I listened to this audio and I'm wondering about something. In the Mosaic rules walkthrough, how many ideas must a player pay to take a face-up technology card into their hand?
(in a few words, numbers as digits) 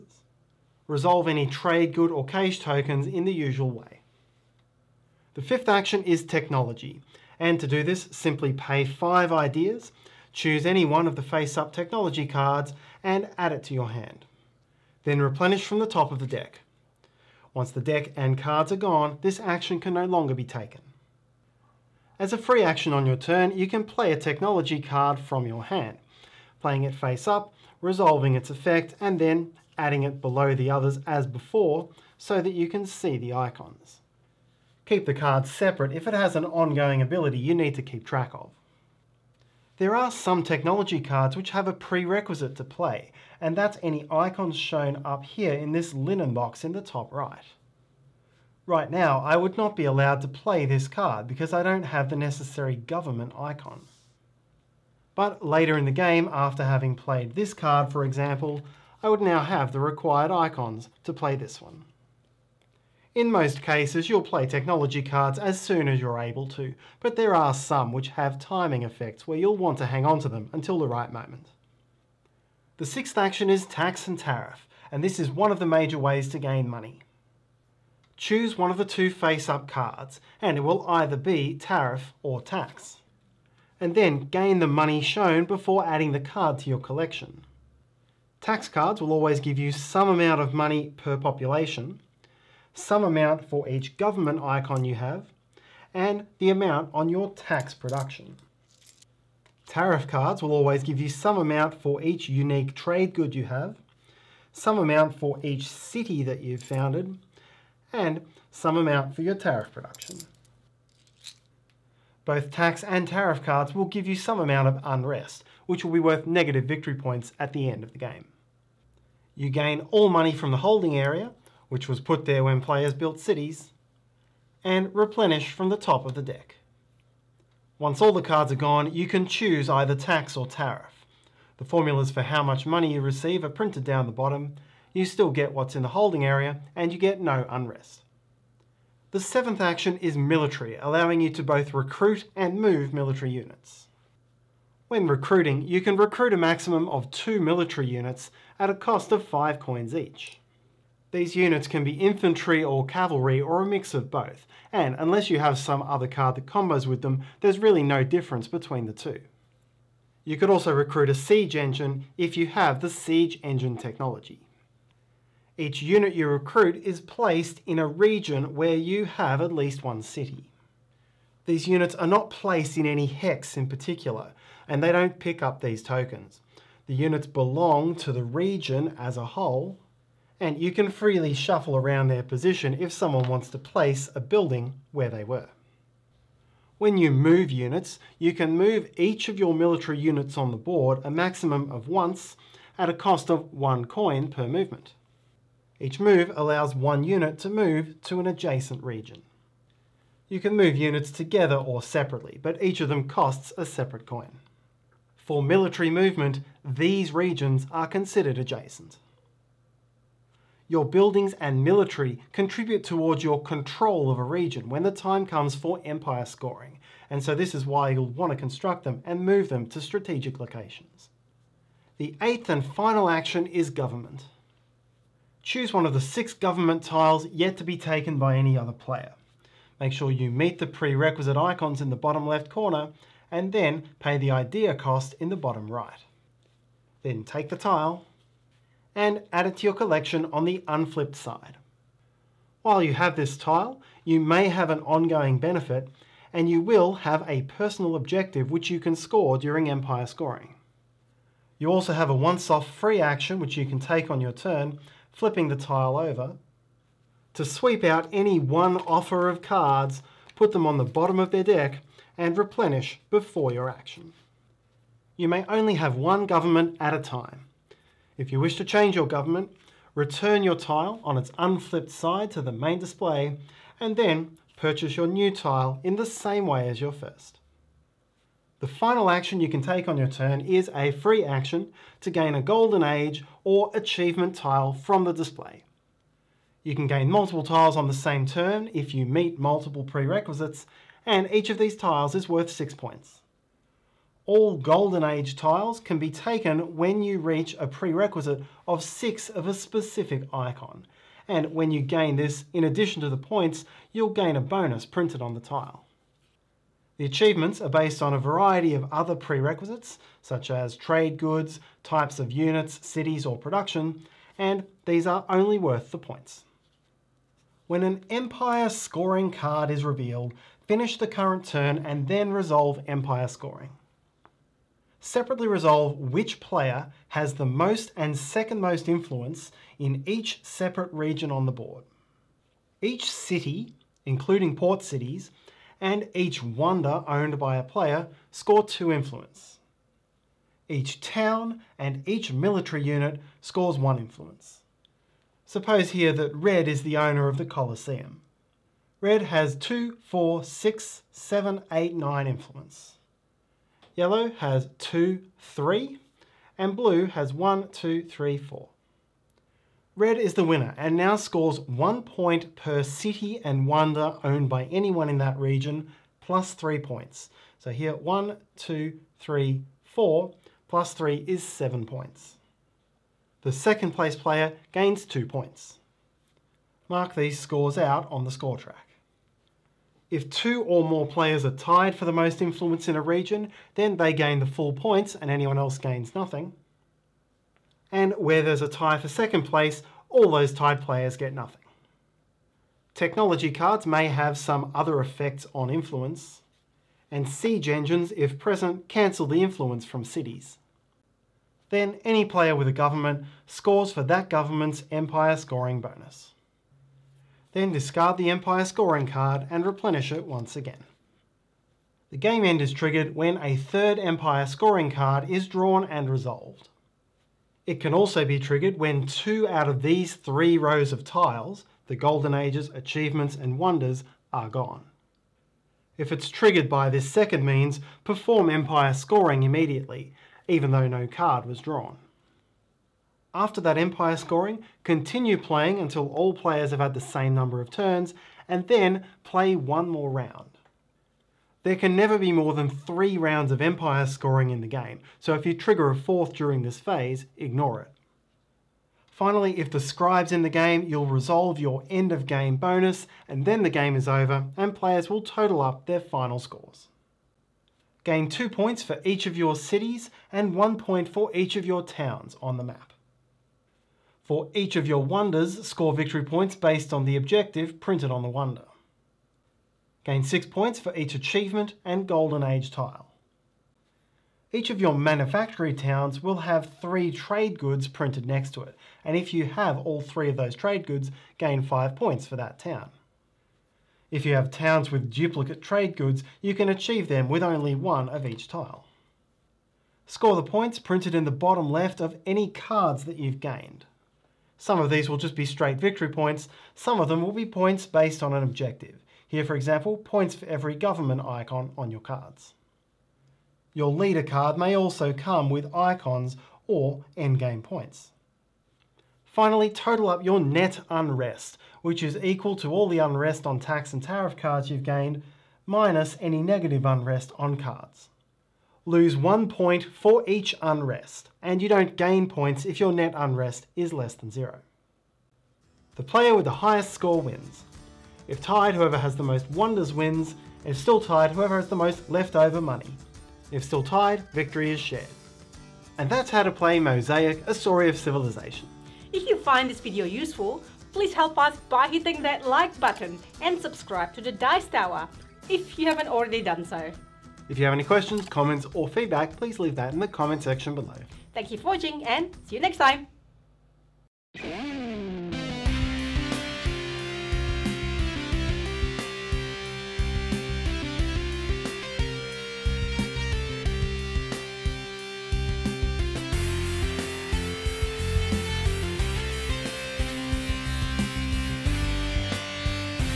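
5.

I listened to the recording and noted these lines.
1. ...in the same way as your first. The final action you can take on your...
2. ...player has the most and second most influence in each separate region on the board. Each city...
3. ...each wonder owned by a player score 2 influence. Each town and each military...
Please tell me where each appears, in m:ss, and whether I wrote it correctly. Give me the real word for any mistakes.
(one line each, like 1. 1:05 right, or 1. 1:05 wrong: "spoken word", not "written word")
1. 4:35 right
2. 5:26 right
3. 5:36 right.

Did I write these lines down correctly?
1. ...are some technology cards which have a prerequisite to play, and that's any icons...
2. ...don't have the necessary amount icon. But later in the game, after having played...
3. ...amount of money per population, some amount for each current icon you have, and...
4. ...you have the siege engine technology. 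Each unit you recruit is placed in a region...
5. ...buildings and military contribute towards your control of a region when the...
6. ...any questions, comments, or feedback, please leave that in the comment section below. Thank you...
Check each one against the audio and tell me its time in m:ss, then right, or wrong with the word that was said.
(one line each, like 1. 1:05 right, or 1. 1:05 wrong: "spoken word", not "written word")
1. 0:39 right
2. 0:51 wrong: "government", not "amount"
3. 1:30 wrong: "government", not "current"
4. 2:42 right
5. 3:30 right
6. 9:07 right.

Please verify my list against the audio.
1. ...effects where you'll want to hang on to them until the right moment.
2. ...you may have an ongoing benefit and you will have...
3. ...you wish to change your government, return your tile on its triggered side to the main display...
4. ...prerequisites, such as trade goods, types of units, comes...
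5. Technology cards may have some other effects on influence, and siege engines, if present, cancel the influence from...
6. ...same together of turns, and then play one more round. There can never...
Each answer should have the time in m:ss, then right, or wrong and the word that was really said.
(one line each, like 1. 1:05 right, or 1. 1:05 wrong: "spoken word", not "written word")
1. 1:08 right
2. 4:04 right
3. 4:28 wrong: "unflipped", not "triggered"
4. 5:09 wrong: "cities", not "comes"
5. 6:32 right
6. 7:17 wrong: "number", not "together".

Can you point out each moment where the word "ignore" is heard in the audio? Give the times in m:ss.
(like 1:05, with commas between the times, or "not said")
7:27.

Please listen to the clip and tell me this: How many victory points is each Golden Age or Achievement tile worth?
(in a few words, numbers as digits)
6.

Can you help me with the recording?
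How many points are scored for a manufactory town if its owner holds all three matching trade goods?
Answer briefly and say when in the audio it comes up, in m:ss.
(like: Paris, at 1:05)
5, at 8:01.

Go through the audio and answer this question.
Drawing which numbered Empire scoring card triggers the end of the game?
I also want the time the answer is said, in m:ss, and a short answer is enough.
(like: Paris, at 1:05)
third, at 6:53.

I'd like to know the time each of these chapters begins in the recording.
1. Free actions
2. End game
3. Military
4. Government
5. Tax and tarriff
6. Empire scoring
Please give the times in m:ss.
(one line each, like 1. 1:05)
1. 4:37
2. 6:50
3. 2:17
4. 3:40
5. 1:11
6. 5:16.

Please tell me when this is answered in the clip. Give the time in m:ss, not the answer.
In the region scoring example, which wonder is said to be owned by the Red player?
5:47.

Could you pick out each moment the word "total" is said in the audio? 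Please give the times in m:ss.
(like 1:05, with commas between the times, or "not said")
7:35, 8:29.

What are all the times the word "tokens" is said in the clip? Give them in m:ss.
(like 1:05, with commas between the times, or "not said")
0:02, 2:55.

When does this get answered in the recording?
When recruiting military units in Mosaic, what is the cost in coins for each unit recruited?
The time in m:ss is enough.
2:29.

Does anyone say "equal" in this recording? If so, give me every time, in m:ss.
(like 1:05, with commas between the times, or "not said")
8:32.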